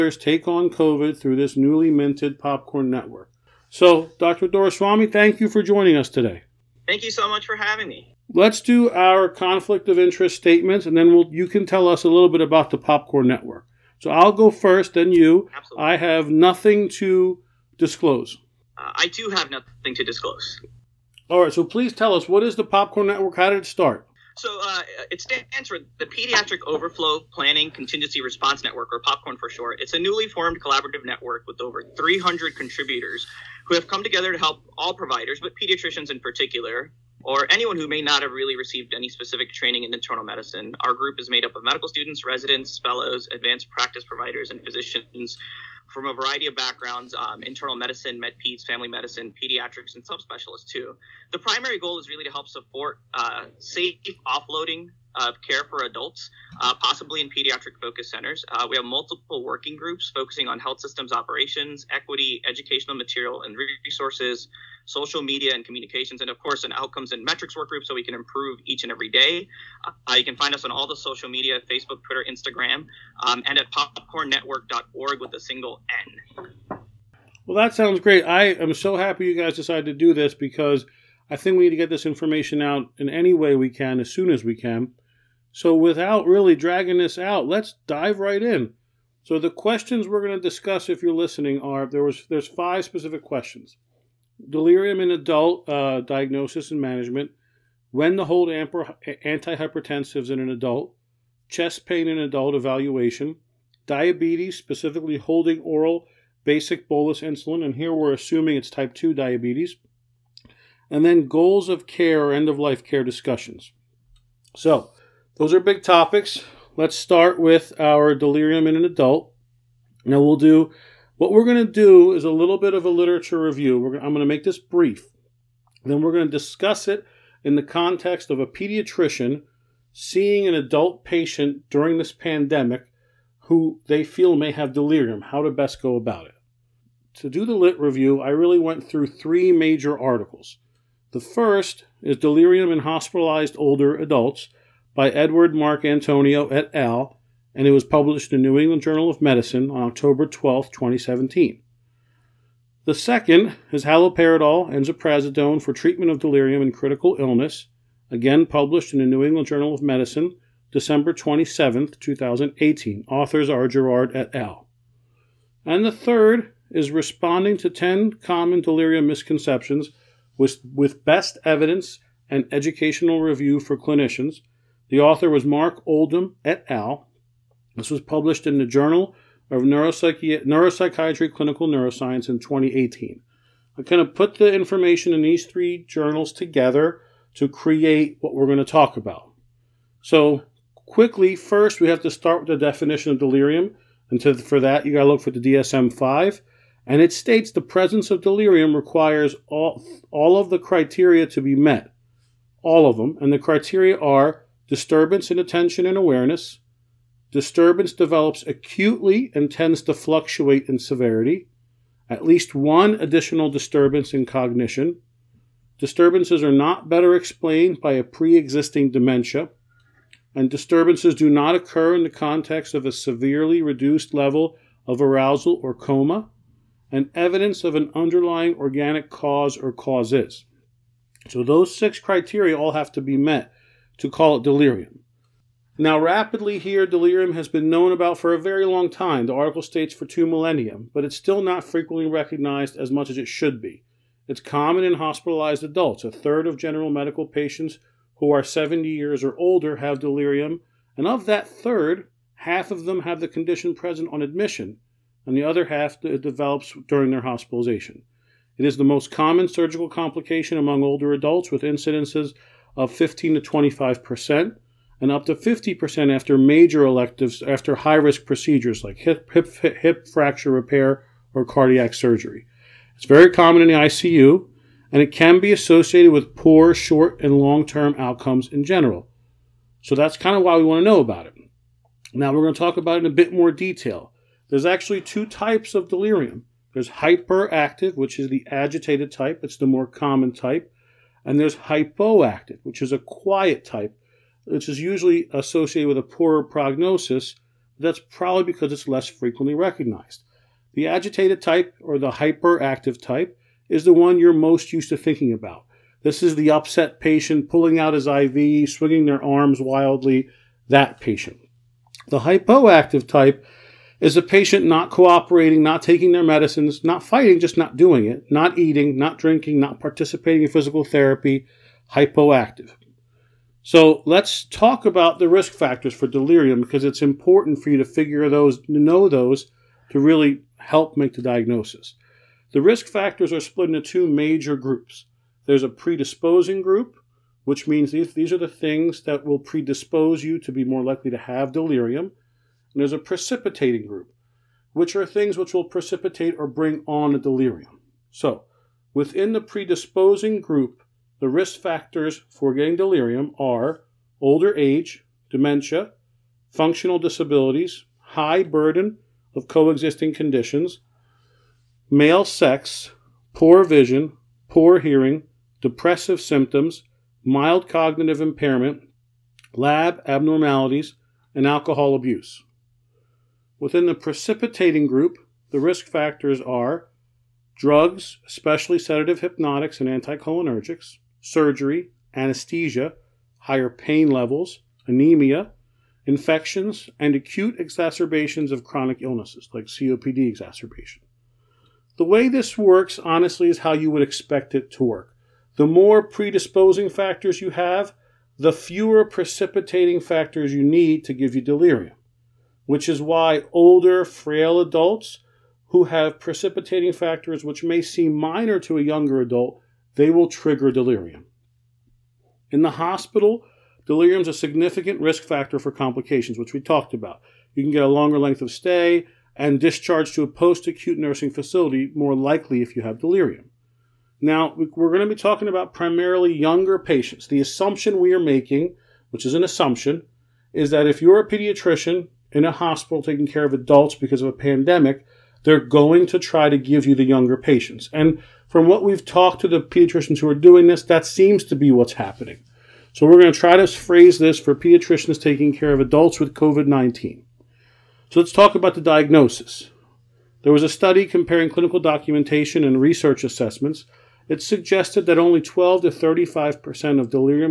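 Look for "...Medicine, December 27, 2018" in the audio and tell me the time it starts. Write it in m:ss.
2:39.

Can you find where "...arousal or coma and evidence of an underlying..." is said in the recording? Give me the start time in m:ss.
3:45.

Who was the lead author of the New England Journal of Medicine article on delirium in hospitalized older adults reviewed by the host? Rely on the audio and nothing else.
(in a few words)
Edward Marcantonio.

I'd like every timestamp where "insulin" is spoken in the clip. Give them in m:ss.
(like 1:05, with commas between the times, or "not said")
1:47.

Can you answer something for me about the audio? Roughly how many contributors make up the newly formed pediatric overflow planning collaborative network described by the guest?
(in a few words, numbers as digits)
over 300.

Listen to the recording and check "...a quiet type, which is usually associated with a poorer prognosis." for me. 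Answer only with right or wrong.
right.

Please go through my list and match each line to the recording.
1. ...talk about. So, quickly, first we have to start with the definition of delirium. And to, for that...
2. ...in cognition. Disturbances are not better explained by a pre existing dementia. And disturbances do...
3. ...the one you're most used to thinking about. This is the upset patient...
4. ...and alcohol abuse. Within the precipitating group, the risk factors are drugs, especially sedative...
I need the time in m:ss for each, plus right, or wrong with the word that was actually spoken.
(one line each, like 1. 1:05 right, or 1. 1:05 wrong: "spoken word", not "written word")
1. 3:08 right
2. 3:34 right
3. 5:03 right
4. 6:11 right.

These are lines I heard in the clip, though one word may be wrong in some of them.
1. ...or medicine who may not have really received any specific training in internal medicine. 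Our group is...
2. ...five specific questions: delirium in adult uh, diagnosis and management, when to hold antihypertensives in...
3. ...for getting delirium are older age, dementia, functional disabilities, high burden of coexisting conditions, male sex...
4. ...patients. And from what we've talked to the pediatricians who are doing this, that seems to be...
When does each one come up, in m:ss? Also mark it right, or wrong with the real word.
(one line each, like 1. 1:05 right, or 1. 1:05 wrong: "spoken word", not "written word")
1. 0:37 wrong: "anyone", not "medicine"
2. 1:32 right
3. 5:52 right
4. 7:17 right.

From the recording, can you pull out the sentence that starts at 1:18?
I am so happy you guys decided to do this because.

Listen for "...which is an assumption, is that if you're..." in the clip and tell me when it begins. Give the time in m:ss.
7:09.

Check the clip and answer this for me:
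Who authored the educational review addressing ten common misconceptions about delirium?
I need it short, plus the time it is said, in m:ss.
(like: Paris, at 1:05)
Mark Oldham, at 2:55.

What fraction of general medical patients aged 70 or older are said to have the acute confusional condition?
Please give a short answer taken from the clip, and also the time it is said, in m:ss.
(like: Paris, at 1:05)
a third, at 4:06.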